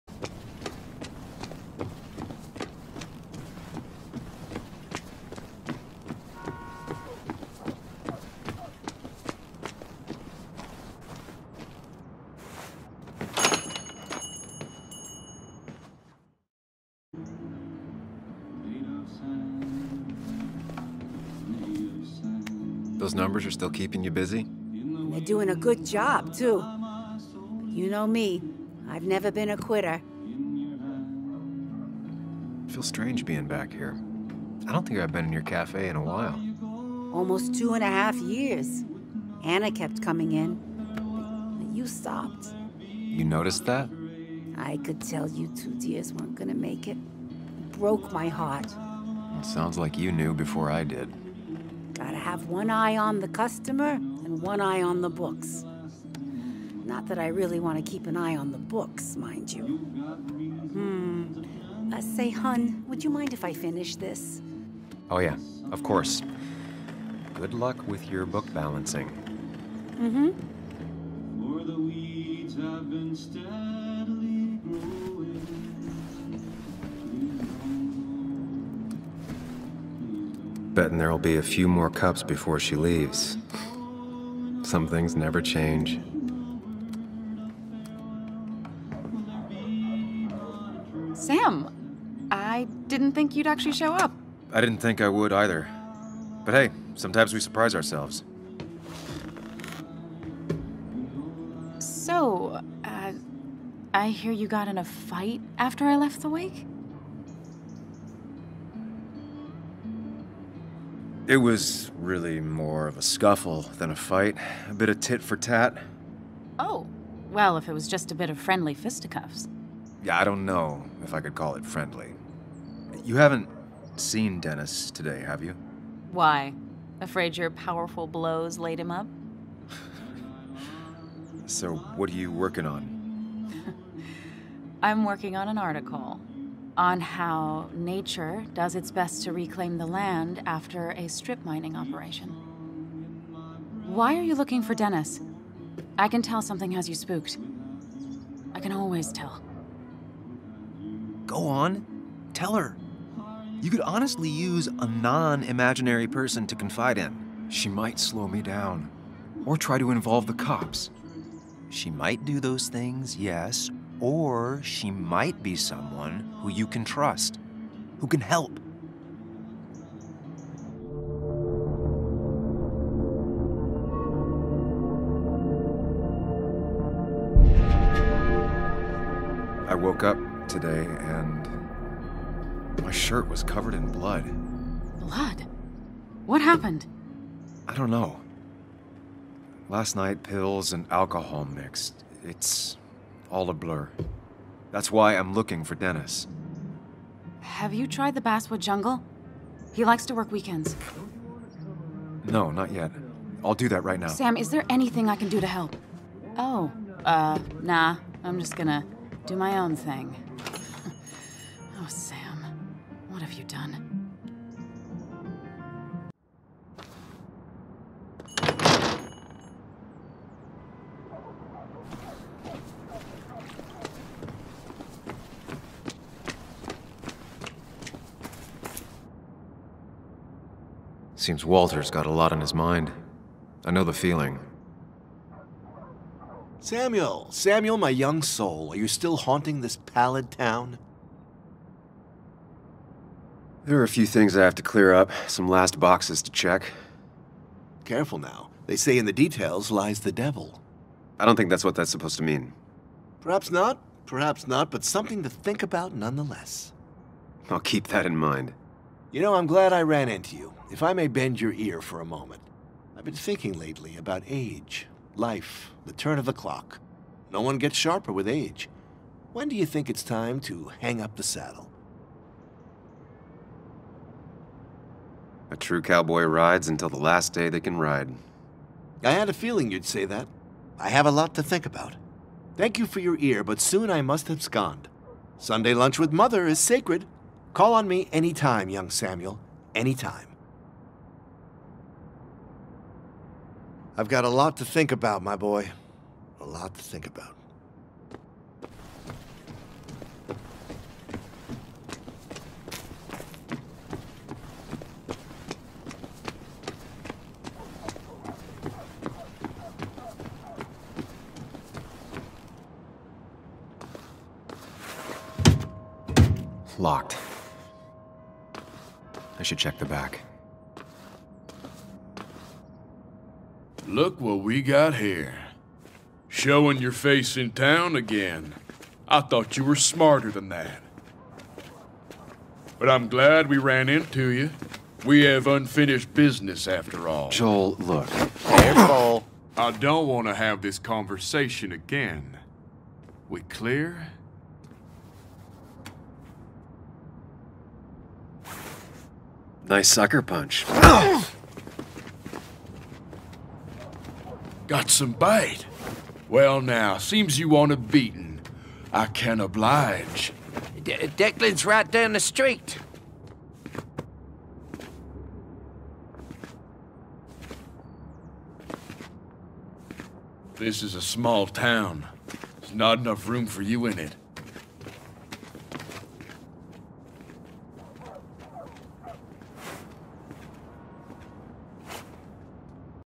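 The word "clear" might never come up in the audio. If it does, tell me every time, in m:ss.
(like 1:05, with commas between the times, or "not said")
4:04, 5:43.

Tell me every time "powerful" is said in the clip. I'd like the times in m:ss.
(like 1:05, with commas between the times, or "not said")
2:07.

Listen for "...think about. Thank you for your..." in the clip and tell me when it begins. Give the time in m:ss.
4:41.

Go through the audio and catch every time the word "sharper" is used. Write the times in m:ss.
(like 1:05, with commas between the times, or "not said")
4:27.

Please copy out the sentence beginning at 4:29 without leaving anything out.
When do you think it's time to hang up the saddle?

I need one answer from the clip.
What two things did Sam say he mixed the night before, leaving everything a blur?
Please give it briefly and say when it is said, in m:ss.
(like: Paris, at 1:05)
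pills and alcohol, at 3:10.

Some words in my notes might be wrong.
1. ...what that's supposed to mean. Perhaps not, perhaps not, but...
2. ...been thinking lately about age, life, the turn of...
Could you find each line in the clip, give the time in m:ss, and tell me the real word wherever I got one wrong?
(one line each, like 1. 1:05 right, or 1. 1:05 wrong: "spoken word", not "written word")
1. 4:11 right
2. 4:23 right.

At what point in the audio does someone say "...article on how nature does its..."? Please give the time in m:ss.
2:15.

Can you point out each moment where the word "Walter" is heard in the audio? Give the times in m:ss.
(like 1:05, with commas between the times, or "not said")
3:51.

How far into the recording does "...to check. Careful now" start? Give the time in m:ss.
4:06.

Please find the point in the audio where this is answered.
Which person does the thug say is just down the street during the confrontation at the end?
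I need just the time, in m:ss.
6:01.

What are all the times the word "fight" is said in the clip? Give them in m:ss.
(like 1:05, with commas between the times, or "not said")
1:44, 1:53.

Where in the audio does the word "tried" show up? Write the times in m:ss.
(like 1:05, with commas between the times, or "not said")
3:17.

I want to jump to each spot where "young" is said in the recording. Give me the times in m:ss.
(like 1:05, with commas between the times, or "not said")
3:57, 4:48.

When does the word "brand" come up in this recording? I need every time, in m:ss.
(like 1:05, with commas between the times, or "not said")
not said.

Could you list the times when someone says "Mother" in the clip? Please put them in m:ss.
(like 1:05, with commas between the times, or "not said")
4:46.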